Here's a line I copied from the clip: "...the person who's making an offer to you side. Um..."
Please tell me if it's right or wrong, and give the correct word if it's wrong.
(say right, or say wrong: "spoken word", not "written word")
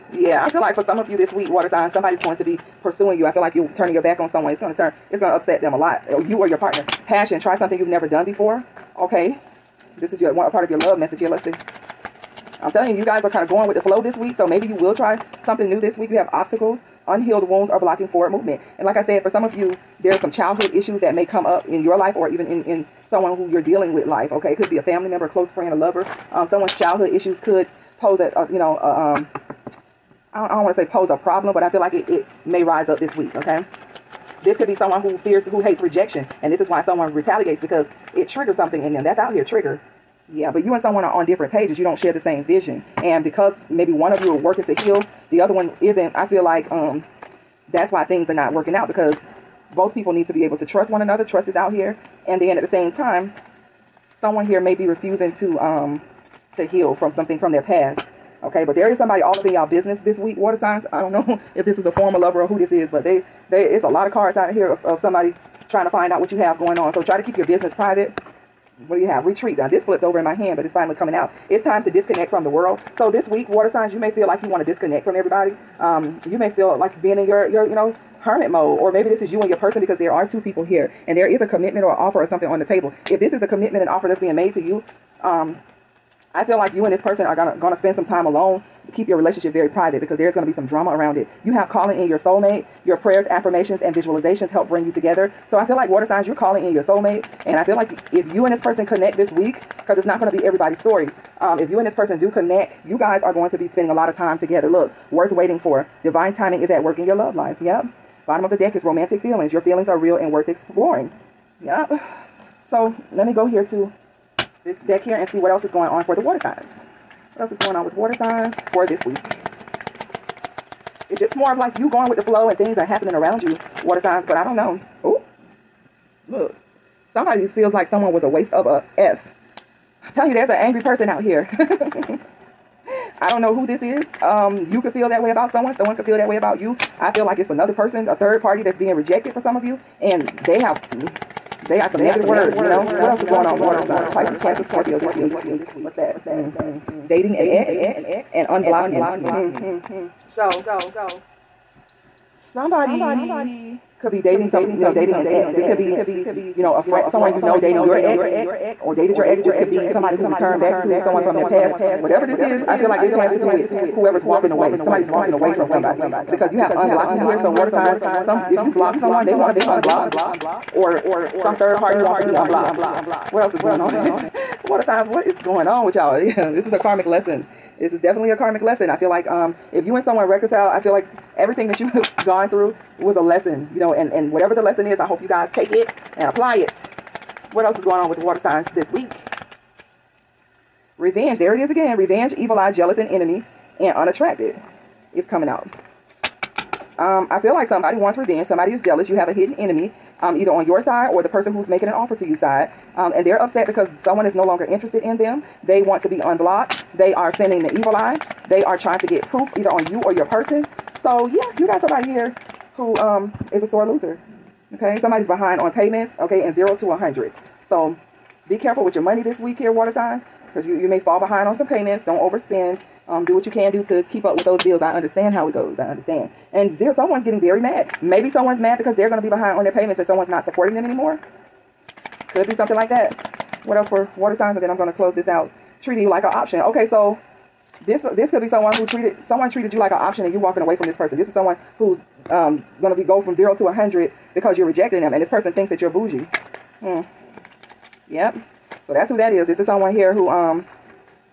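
right.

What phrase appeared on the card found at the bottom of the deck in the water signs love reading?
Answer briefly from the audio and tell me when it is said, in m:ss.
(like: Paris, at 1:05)
Romantic feelings, at 1:48.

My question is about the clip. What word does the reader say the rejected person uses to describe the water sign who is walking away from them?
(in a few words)
Bougie.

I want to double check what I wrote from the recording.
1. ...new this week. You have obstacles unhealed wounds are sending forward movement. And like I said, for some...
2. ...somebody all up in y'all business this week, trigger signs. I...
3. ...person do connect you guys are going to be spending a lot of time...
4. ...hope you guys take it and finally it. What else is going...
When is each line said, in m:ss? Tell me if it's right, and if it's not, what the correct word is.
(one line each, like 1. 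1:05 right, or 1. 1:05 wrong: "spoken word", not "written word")
1. 0:15 wrong: "blocking", not "sending"
2. 0:58 wrong: "water", not "trigger"
3. 1:41 right
4. 3:05 wrong: "apply", not "finally".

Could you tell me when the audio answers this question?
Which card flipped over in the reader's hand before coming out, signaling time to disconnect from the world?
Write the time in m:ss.
1:09.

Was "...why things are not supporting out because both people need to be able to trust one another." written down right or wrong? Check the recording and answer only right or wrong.
wrong.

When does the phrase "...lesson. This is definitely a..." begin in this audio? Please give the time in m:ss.
2:57.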